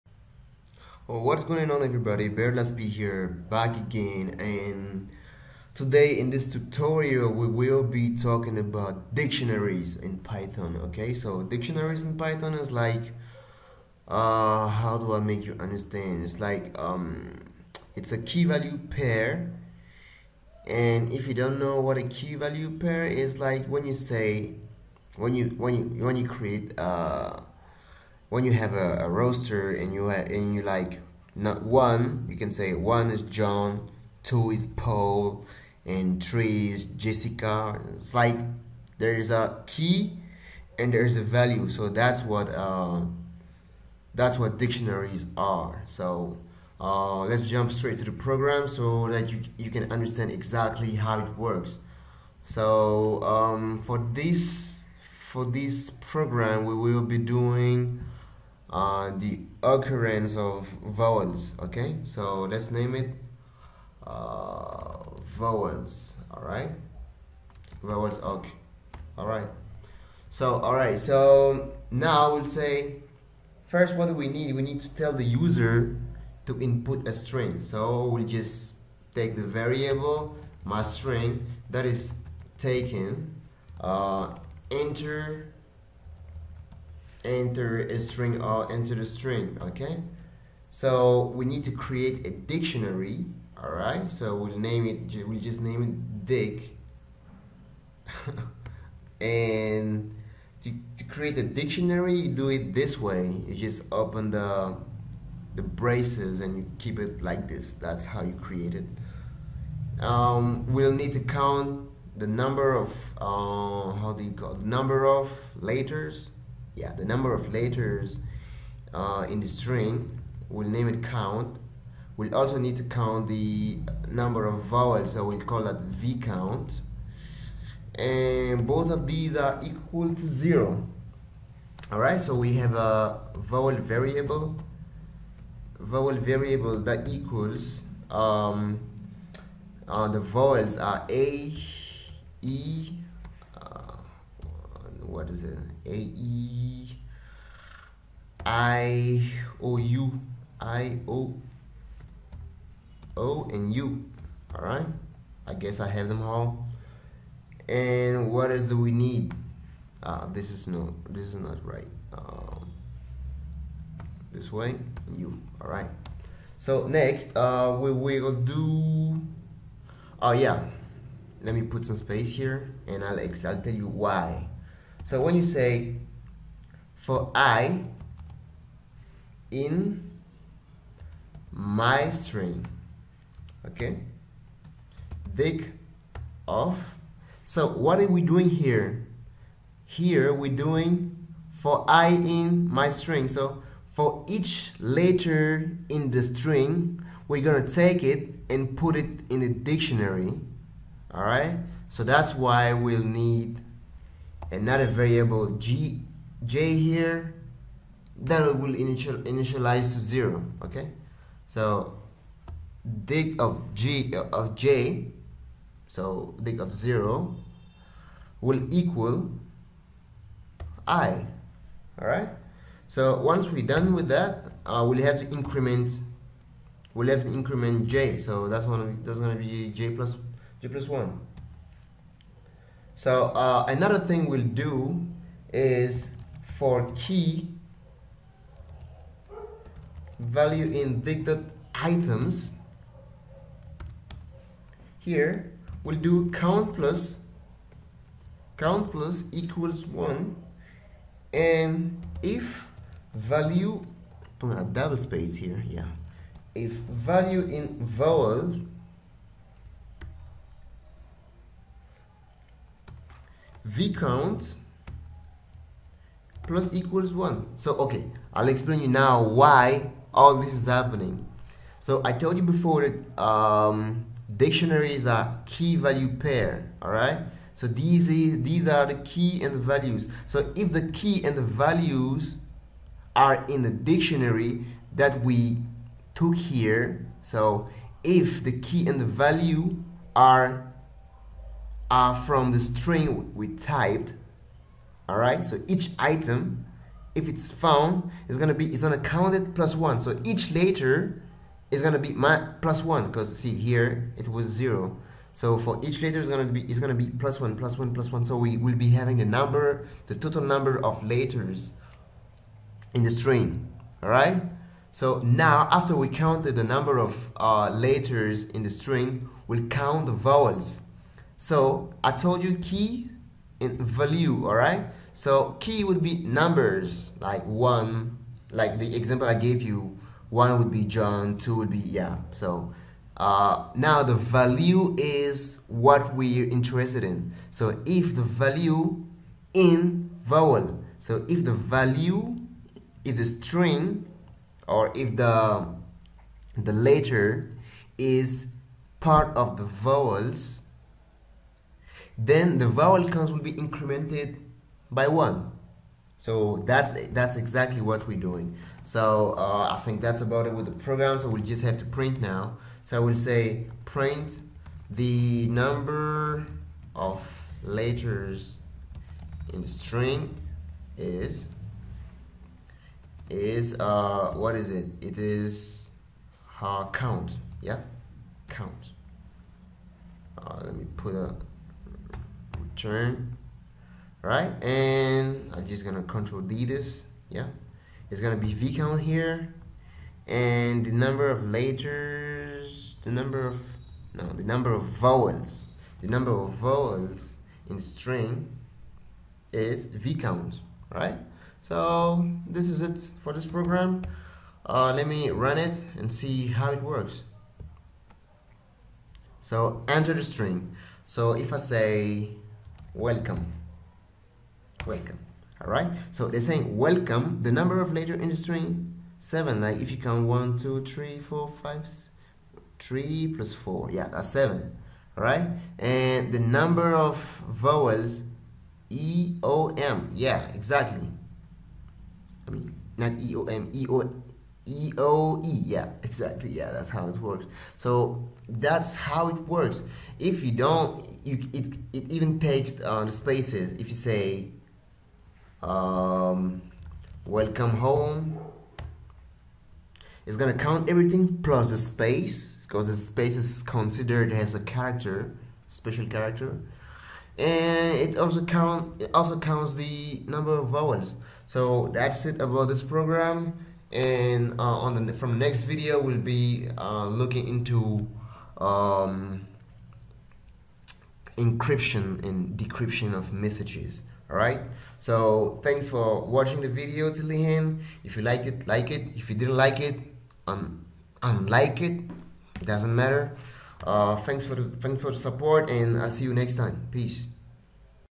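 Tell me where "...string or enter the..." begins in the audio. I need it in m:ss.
1:27.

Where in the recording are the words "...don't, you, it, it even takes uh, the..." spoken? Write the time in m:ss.
7:20.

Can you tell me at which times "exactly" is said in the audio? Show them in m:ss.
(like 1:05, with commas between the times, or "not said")
0:50, 5:57, 7:10, 7:16.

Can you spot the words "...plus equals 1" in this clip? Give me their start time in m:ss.
4:26.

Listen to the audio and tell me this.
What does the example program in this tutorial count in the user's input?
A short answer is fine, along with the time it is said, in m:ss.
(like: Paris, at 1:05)
occurrence of vowels, at 0:59.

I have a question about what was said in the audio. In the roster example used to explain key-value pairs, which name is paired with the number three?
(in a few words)
Jessica.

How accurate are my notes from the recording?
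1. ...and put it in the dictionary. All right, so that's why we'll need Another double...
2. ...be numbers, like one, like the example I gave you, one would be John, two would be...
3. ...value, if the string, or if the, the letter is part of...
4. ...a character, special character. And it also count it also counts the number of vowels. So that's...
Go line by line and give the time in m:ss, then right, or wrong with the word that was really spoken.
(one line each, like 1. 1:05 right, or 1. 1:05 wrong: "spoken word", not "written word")
1. 3:18 wrong: "variable", not "double"
2. 5:26 right
3. 5:41 right
4. 7:34 right.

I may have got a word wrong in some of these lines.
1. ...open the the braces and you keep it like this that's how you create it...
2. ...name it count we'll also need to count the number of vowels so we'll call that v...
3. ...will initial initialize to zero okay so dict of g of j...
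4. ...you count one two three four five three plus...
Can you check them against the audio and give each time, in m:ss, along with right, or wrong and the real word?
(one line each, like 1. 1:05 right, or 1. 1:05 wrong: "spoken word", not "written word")
1. 1:43 right
2. 2:00 right
3. 3:28 right
4. 6:59 right.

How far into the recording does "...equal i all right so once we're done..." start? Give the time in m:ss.
3:38.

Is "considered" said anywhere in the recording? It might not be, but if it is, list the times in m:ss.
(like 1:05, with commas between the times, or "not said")
7:33.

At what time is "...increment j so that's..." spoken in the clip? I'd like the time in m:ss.
3:47.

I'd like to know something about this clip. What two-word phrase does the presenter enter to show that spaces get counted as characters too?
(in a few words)
welcome home.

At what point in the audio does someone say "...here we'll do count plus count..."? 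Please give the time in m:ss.
4:04.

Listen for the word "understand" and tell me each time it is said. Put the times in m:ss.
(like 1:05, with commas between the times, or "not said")
0:15, 0:49.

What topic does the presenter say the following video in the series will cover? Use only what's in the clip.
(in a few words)
encryption and decryption.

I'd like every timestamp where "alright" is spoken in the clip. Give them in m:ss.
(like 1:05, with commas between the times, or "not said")
2:11, 4:36.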